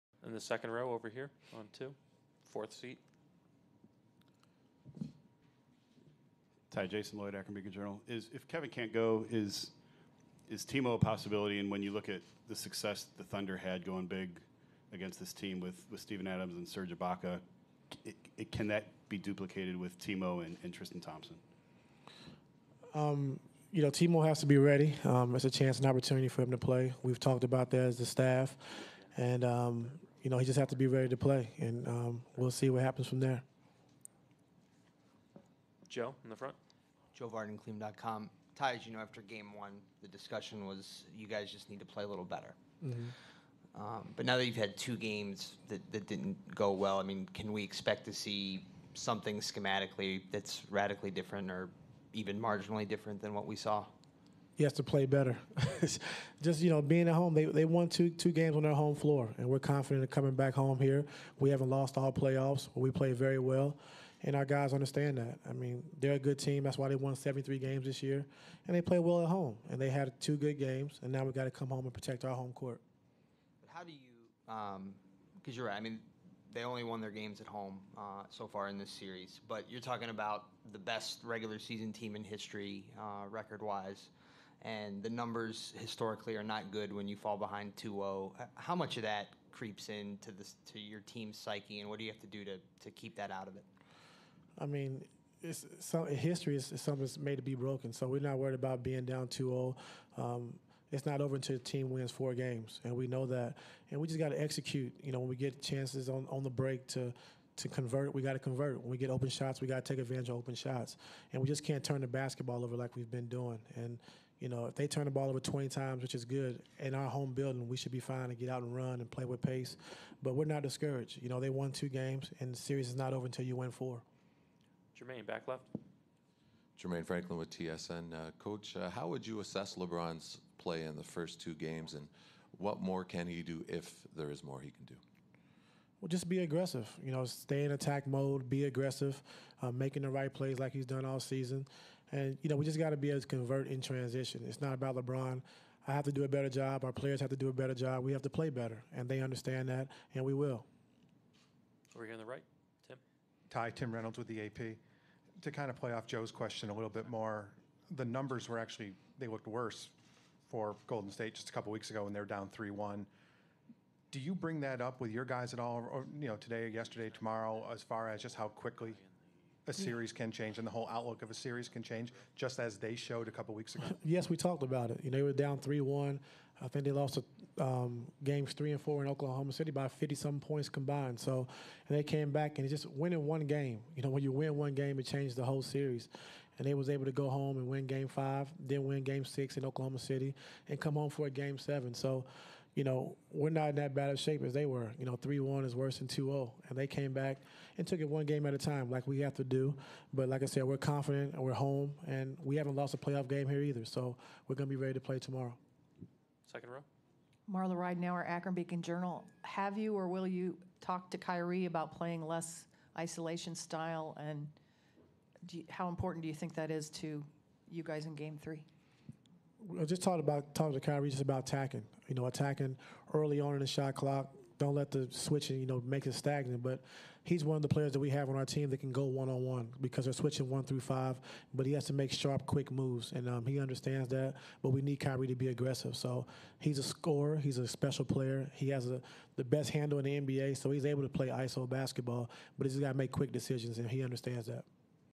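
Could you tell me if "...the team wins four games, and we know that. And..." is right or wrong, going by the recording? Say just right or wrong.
right.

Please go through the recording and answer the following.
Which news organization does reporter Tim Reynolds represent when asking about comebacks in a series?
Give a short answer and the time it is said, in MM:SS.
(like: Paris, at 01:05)
AP, at 02:34.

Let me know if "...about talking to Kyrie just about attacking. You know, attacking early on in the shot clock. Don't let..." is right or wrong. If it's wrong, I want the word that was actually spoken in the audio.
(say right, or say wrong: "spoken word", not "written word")
right.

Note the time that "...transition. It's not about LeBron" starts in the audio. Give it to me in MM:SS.
02:23.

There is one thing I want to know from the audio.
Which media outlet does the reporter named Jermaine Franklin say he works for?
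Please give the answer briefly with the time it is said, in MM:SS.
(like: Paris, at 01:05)
TSN, at 02:07.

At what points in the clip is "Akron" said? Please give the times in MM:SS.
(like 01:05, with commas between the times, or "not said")
00:07, 03:28.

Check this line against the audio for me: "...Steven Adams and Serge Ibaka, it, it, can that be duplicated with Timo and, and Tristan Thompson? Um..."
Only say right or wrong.
right.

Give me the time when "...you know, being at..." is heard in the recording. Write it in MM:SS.
00:56.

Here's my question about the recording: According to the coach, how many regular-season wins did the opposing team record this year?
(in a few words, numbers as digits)
73.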